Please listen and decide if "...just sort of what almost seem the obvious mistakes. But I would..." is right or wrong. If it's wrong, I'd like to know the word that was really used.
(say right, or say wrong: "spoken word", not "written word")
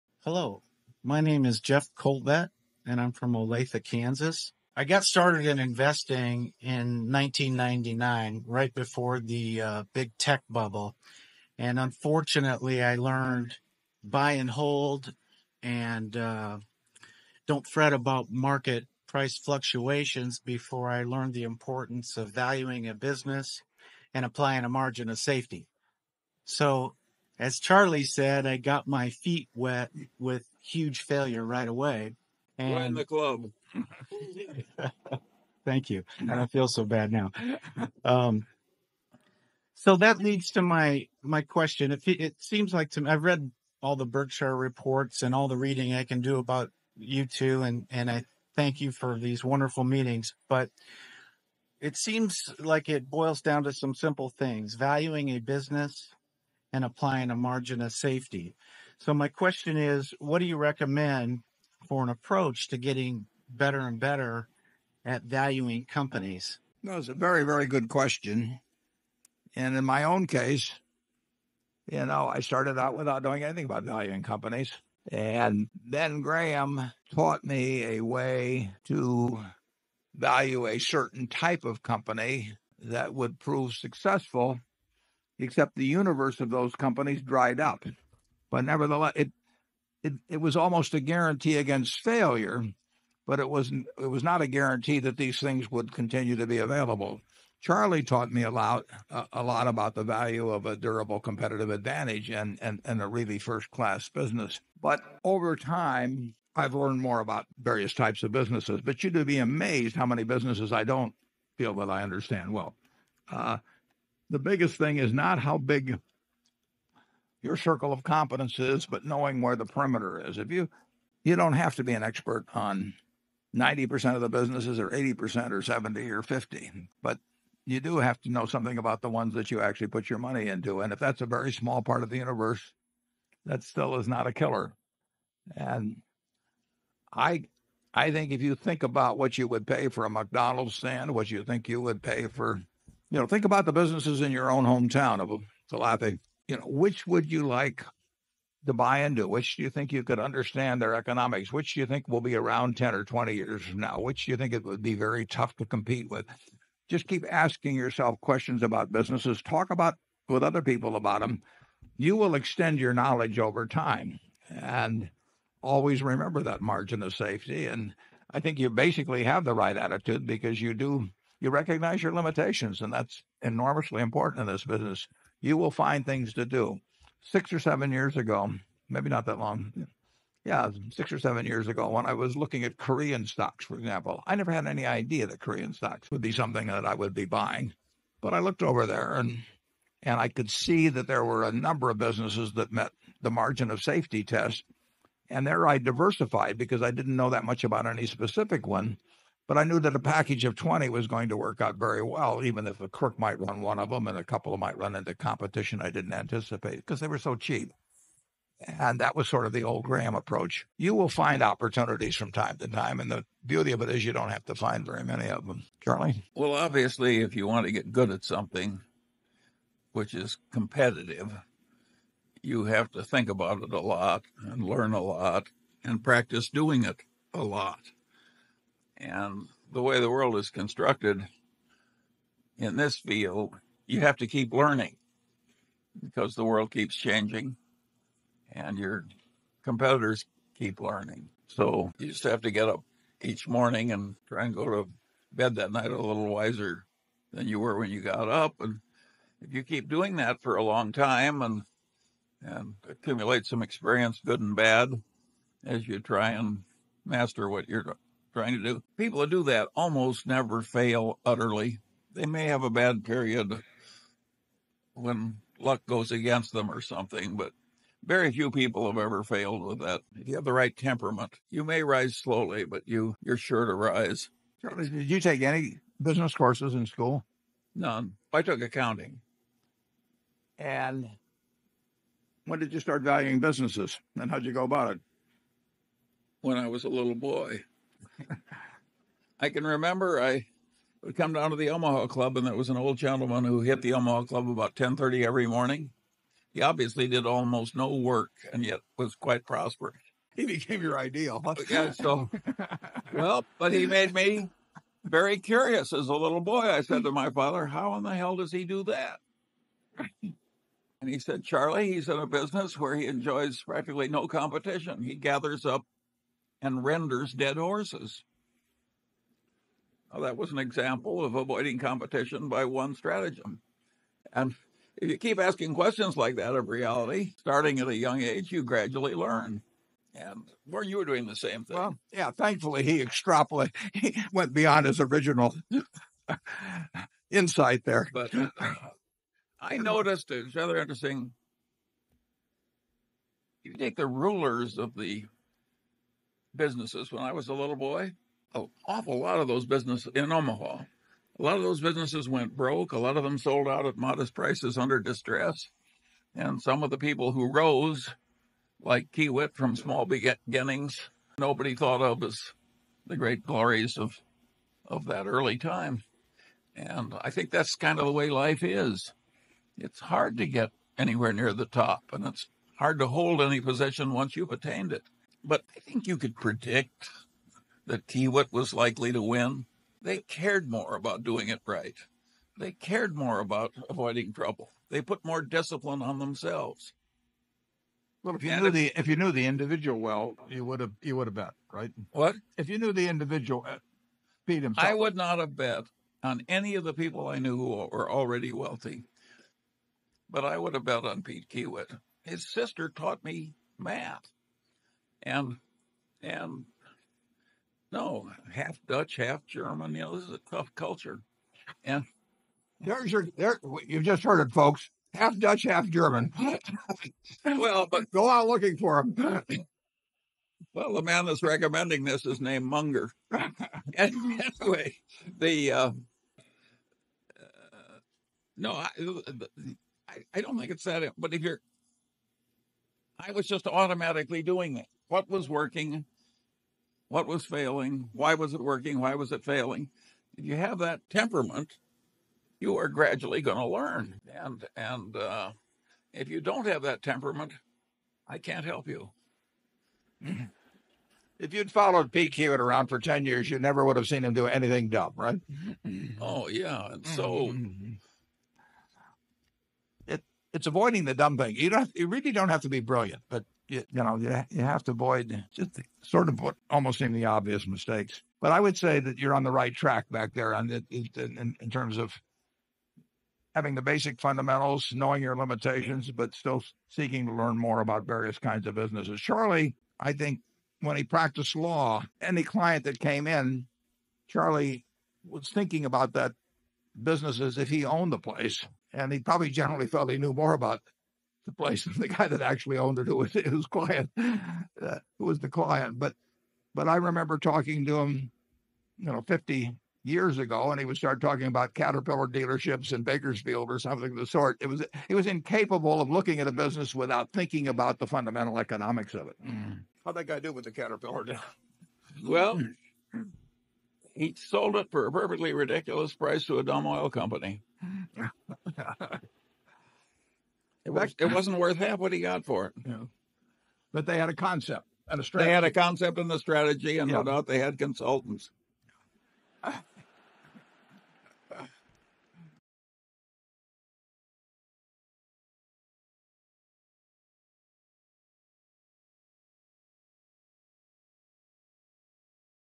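right.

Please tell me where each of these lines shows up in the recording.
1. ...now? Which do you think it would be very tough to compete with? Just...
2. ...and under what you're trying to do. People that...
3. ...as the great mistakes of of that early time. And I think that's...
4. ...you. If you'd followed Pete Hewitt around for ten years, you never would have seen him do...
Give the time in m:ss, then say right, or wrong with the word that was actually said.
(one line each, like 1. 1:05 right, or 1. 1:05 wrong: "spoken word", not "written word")
1. 2:33 right
2. 4:16 wrong: "master", not "under"
3. 6:02 wrong: "glories", not "mistakes"
4. 7:28 right.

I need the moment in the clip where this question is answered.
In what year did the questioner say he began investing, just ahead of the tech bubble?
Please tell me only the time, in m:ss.
0:07.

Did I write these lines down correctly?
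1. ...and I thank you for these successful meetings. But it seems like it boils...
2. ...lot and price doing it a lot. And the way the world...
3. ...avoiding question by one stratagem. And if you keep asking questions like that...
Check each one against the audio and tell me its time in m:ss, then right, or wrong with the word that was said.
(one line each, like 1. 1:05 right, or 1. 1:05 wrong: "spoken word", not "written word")
1. 0:47 wrong: "wonderful", not "successful"
2. 3:45 wrong: "practice", not "price"
3. 5:21 wrong: "competition", not "question".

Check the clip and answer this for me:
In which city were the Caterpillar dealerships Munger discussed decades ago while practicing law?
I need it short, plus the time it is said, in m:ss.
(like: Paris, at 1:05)
Bakersfield, at 8:23.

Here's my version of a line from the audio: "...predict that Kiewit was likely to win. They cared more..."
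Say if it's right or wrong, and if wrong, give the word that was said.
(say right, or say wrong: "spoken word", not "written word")
right.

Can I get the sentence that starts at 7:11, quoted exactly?
But if you're, I was just automatically doing it.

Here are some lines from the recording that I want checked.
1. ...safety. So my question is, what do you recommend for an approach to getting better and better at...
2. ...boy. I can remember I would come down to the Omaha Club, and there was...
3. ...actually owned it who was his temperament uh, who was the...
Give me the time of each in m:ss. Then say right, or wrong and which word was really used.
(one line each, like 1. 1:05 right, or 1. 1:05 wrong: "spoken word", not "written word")
1. 0:57 right
2. 4:47 right
3. 8:12 wrong: "client", not "temperament".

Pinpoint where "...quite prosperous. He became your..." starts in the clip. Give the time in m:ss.
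4:59.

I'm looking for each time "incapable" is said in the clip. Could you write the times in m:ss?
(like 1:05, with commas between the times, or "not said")
8:25.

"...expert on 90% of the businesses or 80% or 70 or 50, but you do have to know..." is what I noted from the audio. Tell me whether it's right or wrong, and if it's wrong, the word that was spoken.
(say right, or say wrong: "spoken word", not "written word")
right.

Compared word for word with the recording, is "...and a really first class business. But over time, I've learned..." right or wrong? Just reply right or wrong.
right.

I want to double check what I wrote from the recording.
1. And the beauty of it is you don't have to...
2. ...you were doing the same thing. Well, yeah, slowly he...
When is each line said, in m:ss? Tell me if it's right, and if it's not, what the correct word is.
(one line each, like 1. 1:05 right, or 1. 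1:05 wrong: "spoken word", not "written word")
1. 3:33 right
2. 5:30 wrong: "thankfully", not "slowly".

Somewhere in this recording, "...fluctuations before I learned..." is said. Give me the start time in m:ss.
0:19.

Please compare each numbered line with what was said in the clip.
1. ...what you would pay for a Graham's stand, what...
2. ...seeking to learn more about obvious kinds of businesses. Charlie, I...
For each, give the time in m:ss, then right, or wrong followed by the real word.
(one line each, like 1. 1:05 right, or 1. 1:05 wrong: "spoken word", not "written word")
1. 2:19 wrong: "McDonald", not "Graham"
2. 7:56 wrong: "various", not "obvious".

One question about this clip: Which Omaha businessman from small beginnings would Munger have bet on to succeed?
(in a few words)
Pete Kiewit.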